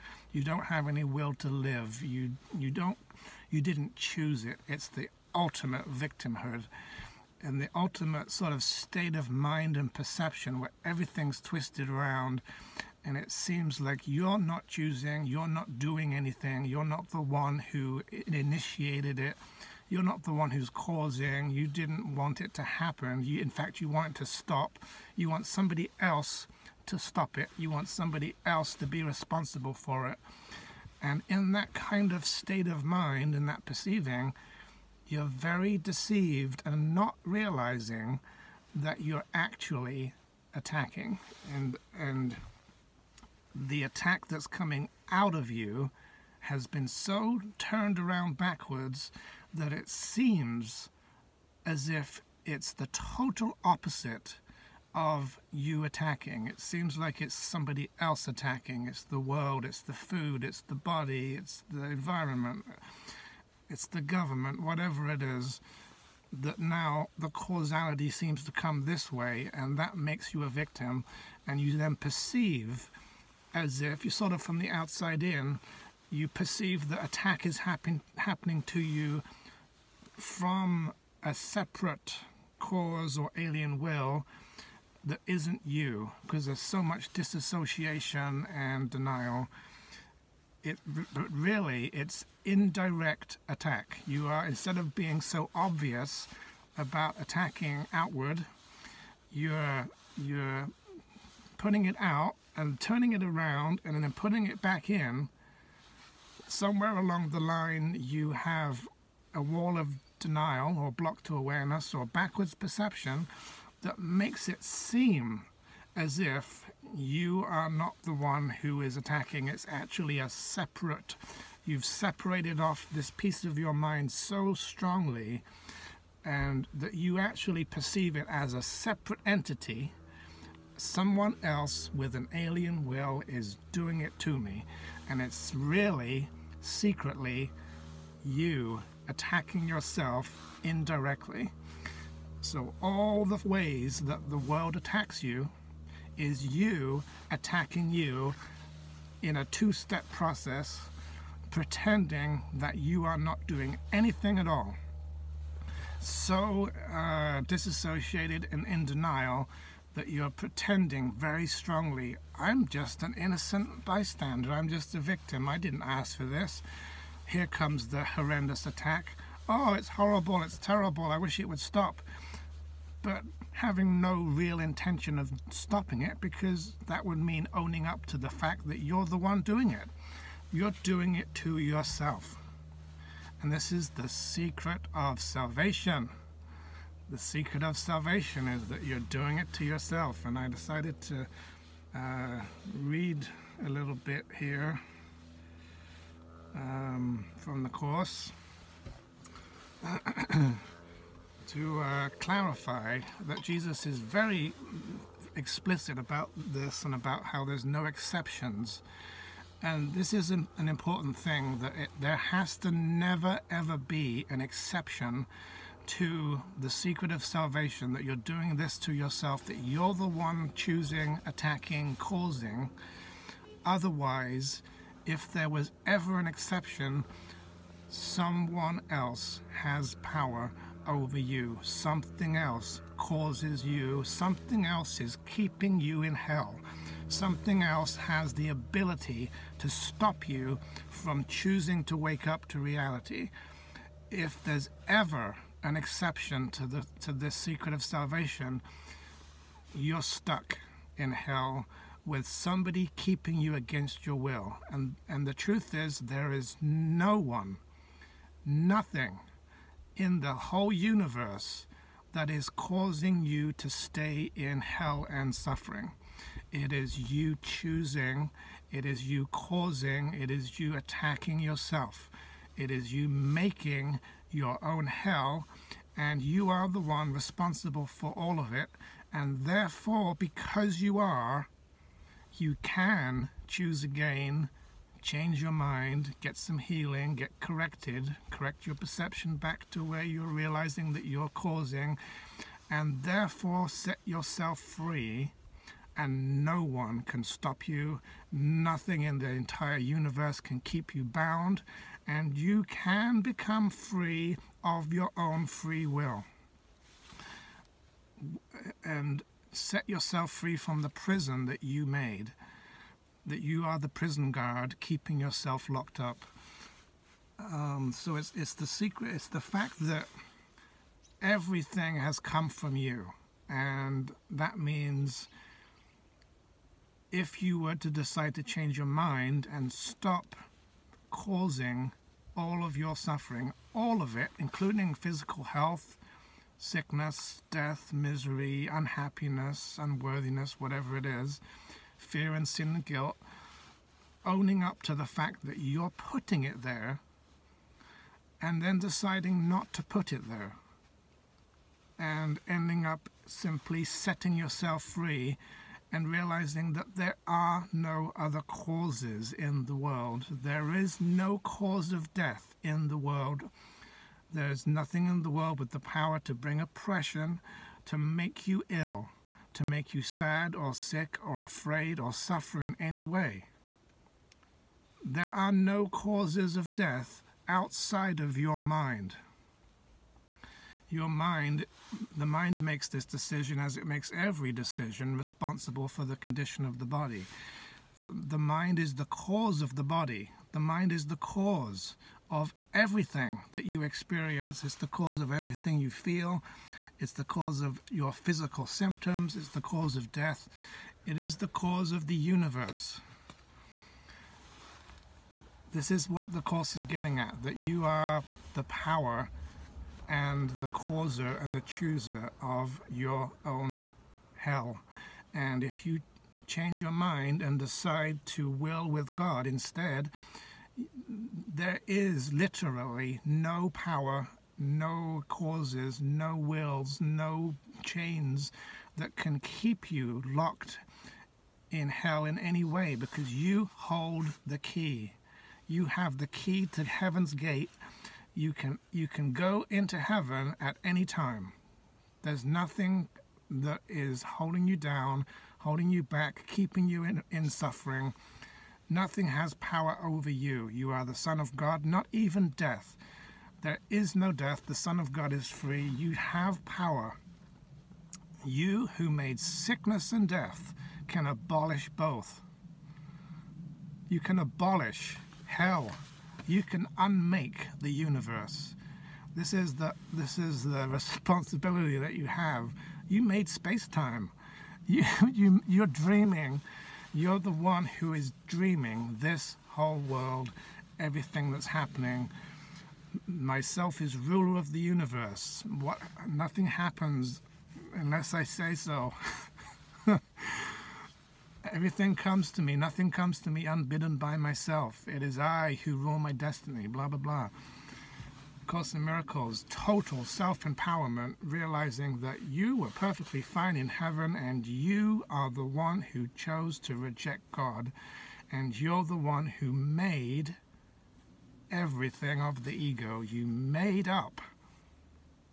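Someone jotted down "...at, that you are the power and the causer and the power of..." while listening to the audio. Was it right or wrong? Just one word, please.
wrong.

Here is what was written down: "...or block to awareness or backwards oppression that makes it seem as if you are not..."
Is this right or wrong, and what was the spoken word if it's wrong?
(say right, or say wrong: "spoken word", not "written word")
wrong: "perception", not "oppression".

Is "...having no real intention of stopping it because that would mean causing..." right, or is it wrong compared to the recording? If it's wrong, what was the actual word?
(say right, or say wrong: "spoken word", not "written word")
wrong: "owning", not "causing".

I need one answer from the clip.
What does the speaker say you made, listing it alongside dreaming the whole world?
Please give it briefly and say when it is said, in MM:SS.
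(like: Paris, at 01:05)
Space-time, at 07:53.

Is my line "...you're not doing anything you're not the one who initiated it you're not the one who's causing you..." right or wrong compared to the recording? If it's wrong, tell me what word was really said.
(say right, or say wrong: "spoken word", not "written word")
right.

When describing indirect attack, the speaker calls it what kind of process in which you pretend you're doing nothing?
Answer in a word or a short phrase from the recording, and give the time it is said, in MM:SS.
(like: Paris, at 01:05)
A two-step process, at 02:29.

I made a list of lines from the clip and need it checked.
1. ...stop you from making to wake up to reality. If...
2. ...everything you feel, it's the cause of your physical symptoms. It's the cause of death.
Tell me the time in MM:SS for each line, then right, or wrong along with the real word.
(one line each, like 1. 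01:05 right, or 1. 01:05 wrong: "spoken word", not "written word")
1. 03:59 wrong: "choosing", not "making"
2. 06:35 right.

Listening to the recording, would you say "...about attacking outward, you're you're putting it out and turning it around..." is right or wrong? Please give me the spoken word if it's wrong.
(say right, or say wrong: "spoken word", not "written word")
right.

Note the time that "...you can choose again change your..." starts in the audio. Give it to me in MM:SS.
04:42.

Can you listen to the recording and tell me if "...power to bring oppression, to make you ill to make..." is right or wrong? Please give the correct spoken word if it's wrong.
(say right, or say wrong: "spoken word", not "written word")
right.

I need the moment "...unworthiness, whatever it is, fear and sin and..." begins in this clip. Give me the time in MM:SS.
05:39.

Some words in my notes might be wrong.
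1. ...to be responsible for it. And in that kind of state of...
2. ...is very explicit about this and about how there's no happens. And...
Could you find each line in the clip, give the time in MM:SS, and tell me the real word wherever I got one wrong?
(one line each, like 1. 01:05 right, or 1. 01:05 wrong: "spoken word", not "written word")
1. 00:28 right
2. 03:23 wrong: "exceptions", not "happens".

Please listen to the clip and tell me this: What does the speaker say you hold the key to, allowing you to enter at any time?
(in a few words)
Heaven's gate.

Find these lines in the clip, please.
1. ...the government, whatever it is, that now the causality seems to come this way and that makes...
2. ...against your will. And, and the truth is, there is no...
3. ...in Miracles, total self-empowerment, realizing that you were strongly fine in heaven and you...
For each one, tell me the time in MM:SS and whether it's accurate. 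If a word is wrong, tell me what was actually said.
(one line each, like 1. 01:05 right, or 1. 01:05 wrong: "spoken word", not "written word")
1. 01:03 right
2. 04:13 right
3. 08:18 wrong: "perfectly", not "strongly".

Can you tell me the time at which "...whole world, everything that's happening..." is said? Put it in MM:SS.
07:59.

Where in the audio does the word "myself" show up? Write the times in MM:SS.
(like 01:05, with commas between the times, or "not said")
08:03, 08:14.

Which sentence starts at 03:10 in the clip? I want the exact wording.
And I decided to uh, read a little bit here um, from the Course.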